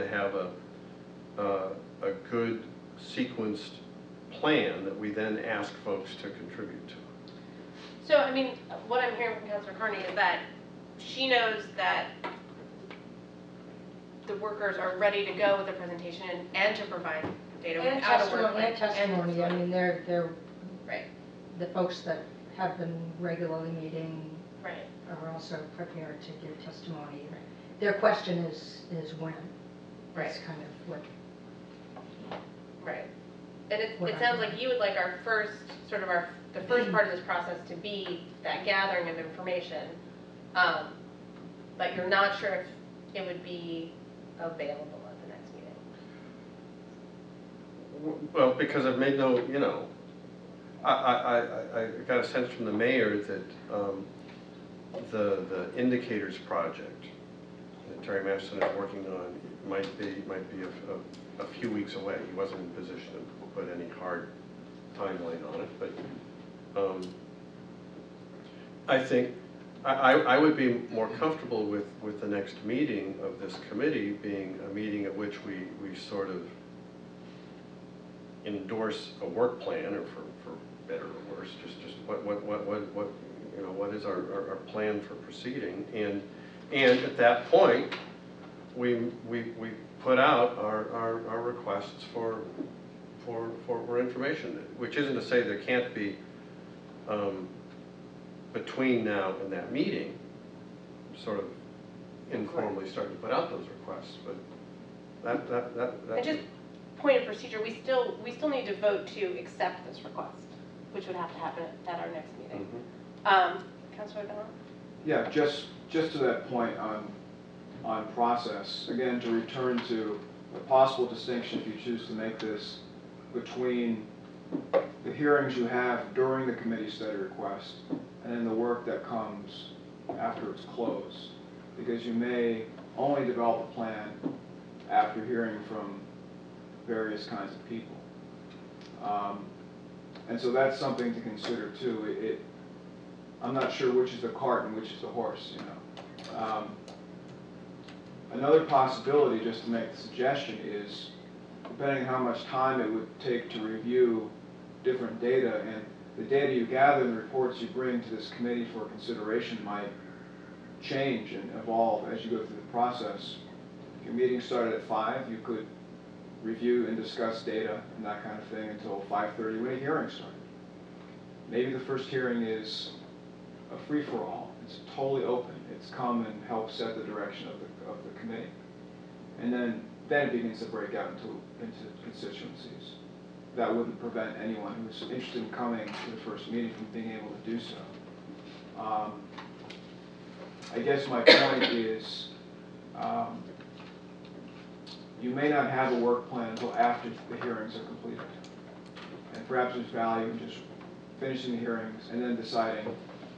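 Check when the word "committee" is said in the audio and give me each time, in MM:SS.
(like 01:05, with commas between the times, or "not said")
01:13, 02:06, 02:38, 02:58.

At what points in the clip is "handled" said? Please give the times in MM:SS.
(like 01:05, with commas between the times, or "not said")
not said.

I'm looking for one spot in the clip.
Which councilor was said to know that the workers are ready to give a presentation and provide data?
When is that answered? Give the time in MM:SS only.
00:09.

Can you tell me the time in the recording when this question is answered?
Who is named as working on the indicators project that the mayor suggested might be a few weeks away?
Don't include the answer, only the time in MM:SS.
00:58.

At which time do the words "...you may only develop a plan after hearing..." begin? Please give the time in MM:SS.
02:12.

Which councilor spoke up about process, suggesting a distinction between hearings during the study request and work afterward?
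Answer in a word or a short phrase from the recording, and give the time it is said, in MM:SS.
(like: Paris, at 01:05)
Councilor Ballard, at 01:53.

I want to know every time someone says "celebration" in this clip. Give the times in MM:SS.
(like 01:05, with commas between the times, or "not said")
not said.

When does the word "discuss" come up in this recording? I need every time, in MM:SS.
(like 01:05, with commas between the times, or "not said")
02:46.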